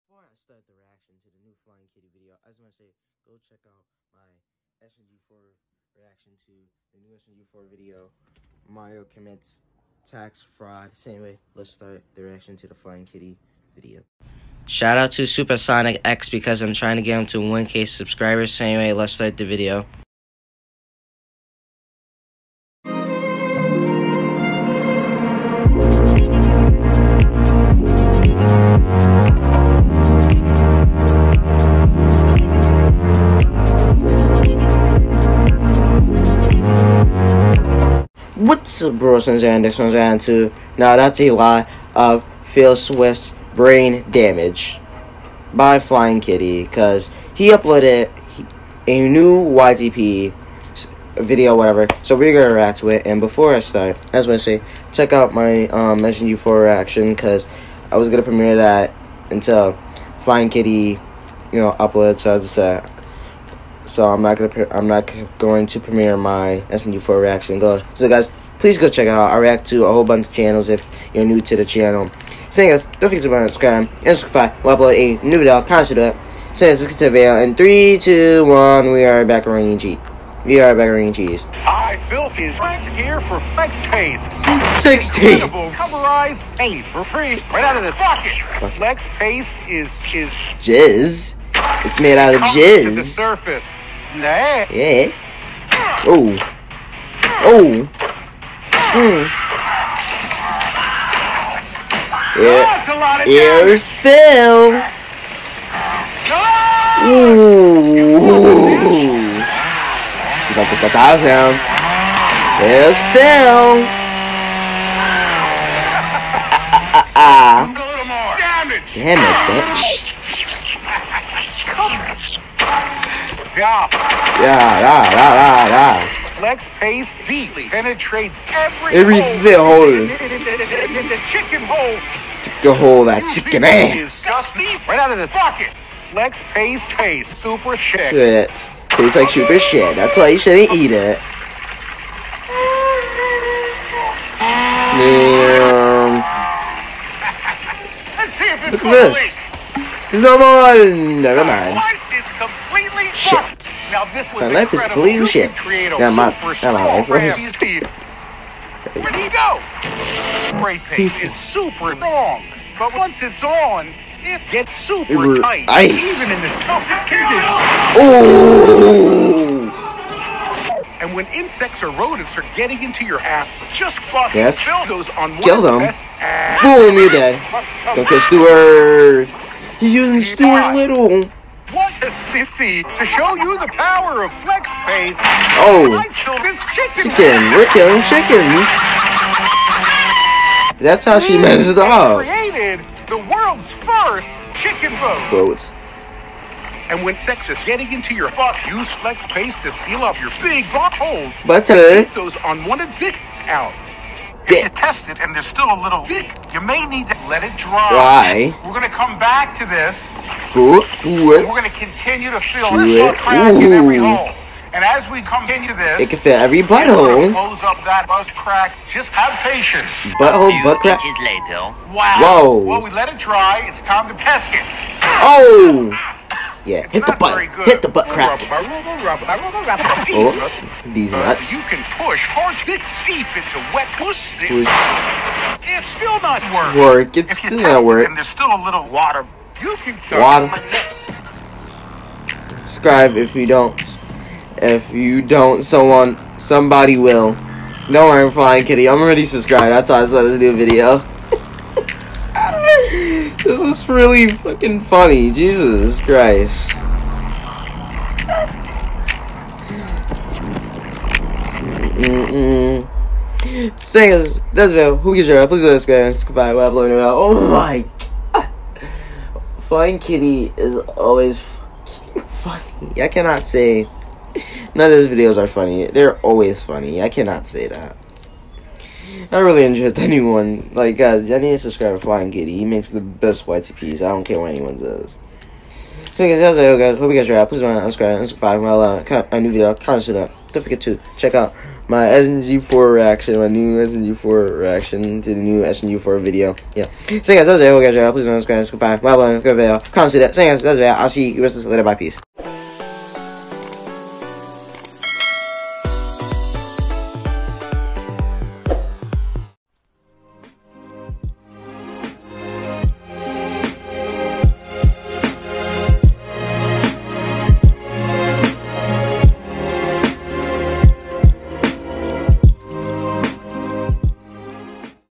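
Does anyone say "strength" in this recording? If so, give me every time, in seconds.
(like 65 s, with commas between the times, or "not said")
82 s.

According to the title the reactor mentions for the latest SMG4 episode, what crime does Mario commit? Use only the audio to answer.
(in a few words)
Tax fraud.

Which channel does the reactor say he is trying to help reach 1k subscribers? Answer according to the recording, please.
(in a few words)
Supersonic X.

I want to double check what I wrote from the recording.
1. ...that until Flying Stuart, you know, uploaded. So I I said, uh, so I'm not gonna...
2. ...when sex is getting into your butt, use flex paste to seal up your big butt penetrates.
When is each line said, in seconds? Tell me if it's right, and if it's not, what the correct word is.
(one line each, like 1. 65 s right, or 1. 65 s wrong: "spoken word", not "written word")
1. 58 s wrong: "Kitty", not "Stuart"
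2. 197 s wrong: "holes", not "penetrates".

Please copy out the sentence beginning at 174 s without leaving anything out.
kill those on one kill them.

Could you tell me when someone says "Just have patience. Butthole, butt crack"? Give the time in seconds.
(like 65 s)
218 s.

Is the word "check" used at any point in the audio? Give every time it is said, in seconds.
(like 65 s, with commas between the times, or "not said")
3 s, 54 s, 68 s, 291 s.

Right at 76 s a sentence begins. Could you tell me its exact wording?
So guys, let's get to the video.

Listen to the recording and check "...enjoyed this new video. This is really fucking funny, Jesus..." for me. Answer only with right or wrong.
wrong.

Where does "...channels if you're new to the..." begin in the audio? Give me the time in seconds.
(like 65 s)
70 s.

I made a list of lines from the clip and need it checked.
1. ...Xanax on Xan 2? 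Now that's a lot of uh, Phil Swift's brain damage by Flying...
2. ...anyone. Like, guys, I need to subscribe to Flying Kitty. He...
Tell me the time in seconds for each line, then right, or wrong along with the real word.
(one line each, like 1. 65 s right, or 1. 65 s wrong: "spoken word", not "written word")
1. 39 s right
2. 279 s right.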